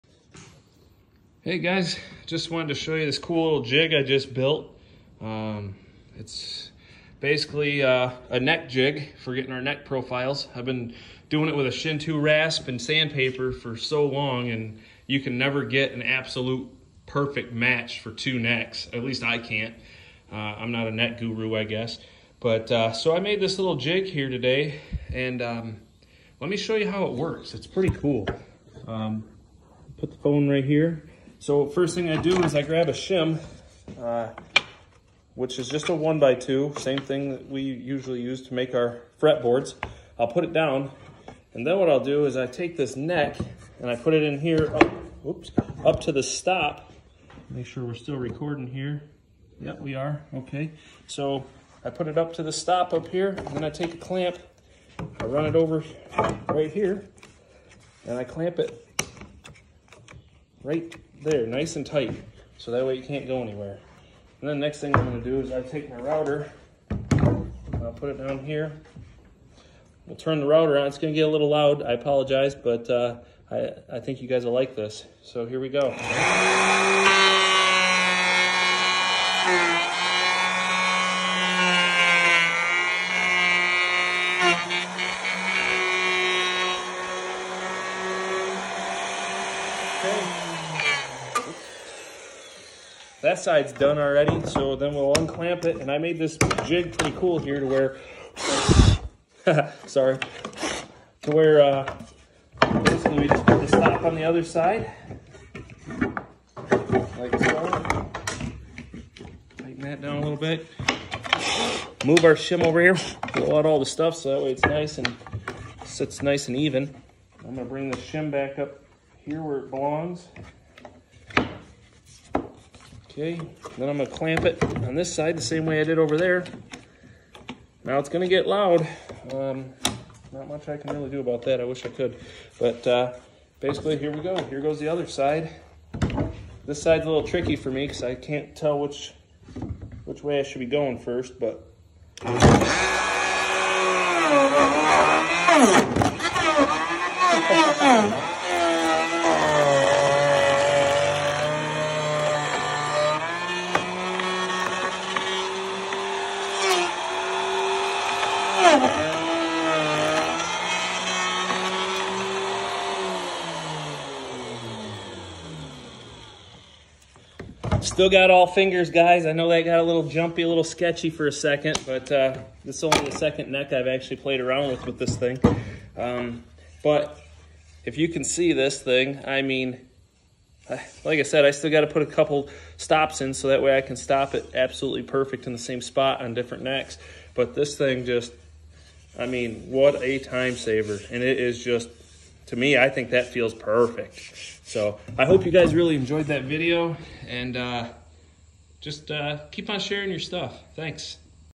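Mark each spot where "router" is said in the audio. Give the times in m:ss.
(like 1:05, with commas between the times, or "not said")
1:05, 1:10.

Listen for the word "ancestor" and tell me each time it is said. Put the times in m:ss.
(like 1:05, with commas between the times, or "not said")
not said.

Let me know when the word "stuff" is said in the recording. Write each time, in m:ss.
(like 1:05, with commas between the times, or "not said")
1:53, 3:20.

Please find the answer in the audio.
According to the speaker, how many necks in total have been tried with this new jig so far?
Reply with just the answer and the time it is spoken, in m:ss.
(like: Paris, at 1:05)
2, at 2:53.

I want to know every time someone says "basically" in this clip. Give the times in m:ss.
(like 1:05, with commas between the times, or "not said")
0:07, 1:42, 2:13.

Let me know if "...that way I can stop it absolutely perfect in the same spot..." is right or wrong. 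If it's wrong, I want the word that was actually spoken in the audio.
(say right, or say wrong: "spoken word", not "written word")
right.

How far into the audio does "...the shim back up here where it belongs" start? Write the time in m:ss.
1:57.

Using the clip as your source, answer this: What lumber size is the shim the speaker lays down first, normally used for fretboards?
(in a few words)
1x2.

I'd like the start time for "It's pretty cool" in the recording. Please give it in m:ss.
0:27.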